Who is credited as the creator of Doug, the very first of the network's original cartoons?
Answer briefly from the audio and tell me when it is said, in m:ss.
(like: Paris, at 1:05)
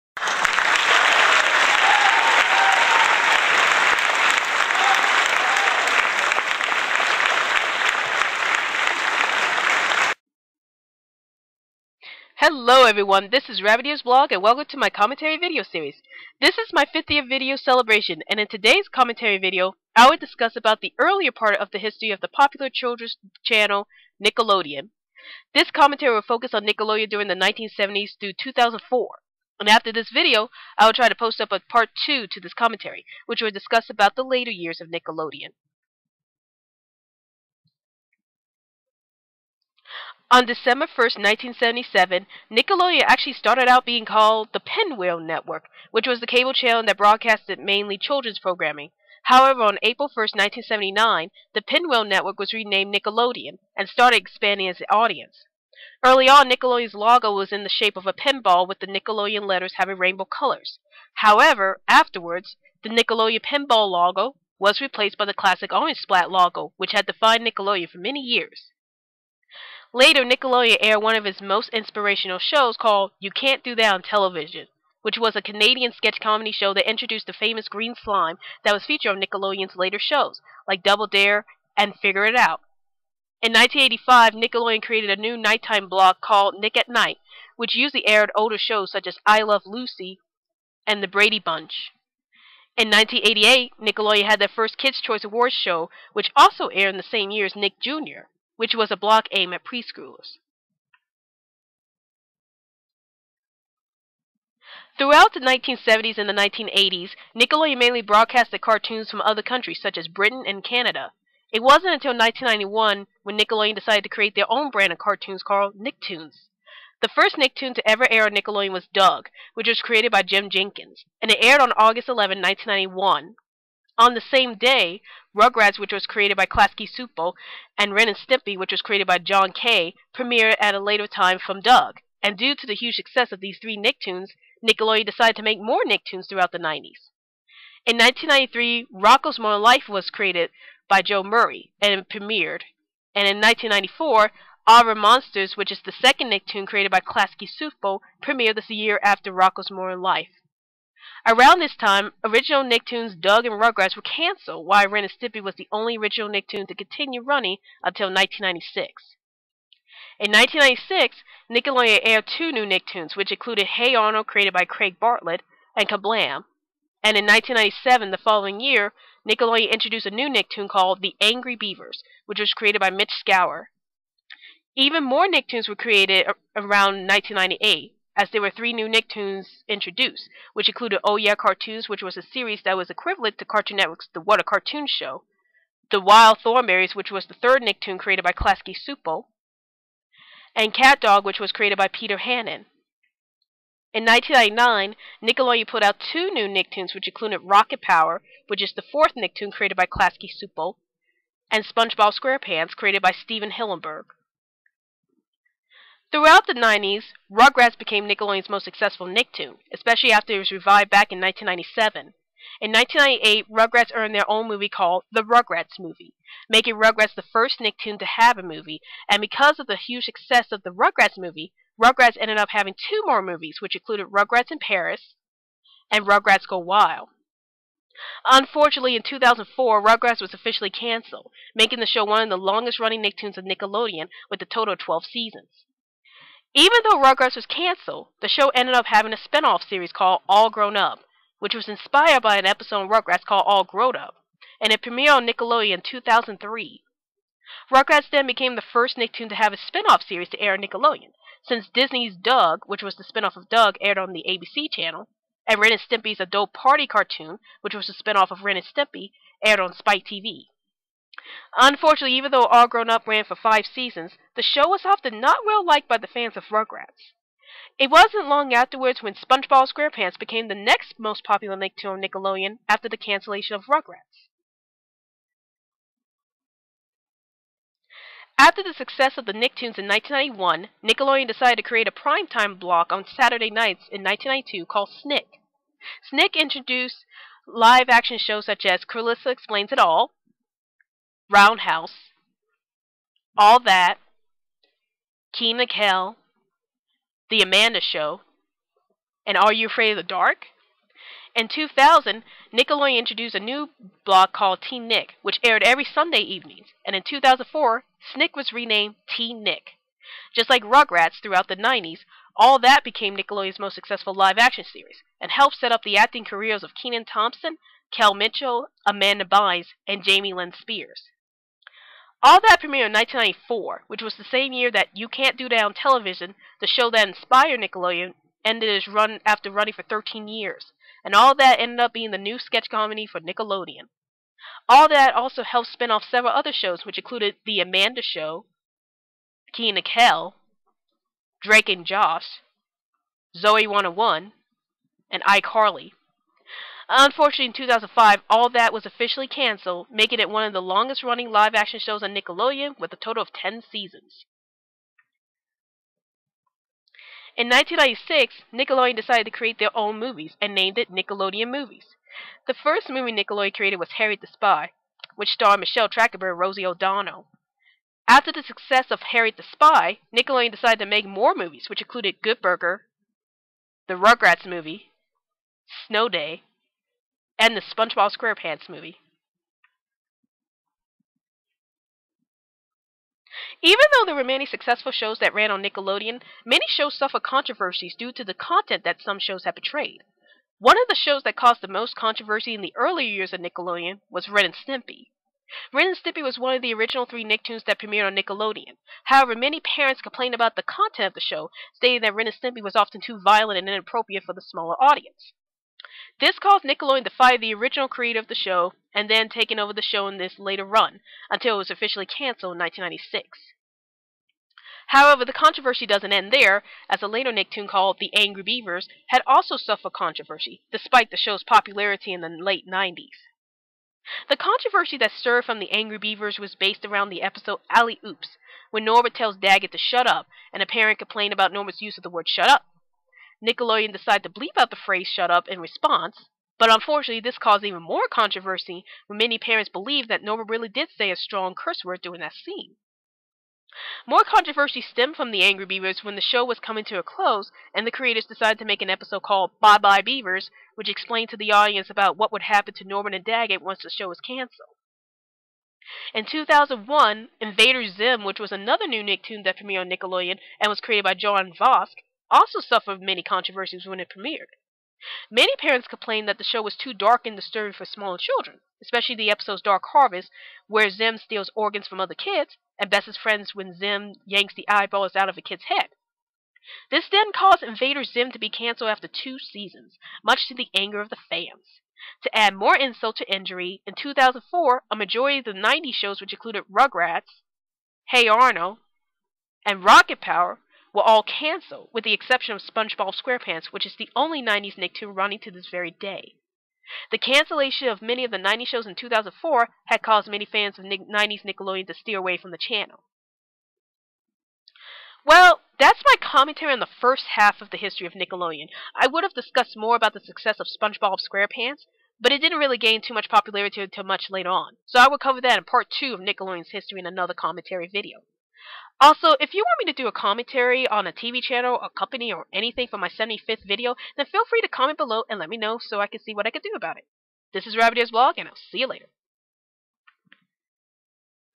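Jim Jenkins, at 2:00.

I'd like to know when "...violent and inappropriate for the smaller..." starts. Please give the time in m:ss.
6:43.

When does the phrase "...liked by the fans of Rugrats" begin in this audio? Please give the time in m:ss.
4:25.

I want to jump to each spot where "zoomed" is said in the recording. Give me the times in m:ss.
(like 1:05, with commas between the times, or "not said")
not said.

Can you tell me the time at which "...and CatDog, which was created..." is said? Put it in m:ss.
3:10.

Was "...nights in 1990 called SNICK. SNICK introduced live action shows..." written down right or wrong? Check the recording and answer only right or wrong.
wrong.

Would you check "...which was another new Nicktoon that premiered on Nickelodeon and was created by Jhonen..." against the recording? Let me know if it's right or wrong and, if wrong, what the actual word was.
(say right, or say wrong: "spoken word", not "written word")
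right.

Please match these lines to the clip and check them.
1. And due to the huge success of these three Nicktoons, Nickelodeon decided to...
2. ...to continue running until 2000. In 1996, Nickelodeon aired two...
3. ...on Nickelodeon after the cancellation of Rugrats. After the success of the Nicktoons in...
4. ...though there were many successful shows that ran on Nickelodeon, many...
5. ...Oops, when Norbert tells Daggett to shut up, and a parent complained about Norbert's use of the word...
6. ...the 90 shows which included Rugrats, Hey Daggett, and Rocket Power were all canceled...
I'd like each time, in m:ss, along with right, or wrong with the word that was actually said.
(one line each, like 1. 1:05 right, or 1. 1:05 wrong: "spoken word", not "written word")
1. 2:12 right
2. 2:36 wrong: "1996", not "2000"
3. 4:31 right
4. 6:23 right
5. 7:08 right
6. 8:05 wrong: "Arnold", not "Daggett".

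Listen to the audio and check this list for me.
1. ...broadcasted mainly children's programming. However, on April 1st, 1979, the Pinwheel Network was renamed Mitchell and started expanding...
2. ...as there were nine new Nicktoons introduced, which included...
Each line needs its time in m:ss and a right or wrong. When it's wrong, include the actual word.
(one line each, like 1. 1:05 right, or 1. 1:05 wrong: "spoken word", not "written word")
1. 0:46 wrong: "Nickelodeon", not "Mitchell"
2. 2:58 wrong: "three", not "nine".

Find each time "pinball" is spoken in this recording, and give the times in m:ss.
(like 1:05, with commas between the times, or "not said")
0:58, 1:03.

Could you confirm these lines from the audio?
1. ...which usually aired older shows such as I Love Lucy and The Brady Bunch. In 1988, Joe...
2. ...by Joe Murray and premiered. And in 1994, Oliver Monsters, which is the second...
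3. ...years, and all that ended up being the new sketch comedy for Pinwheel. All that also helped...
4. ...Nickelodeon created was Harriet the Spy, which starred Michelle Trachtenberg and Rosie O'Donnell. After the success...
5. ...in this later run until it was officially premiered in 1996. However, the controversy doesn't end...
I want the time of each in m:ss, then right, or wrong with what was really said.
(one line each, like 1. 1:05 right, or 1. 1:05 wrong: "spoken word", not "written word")
1. 1:27 wrong: "Nickelodeon", not "Joe"
2. 2:20 right
3. 5:30 wrong: "Nickelodeon", not "Pinwheel"
4. 6:03 right
5. 6:50 wrong: "canceled", not "premiered".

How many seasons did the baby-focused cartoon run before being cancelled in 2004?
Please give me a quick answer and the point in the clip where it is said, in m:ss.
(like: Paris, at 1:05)
12, at 3:54.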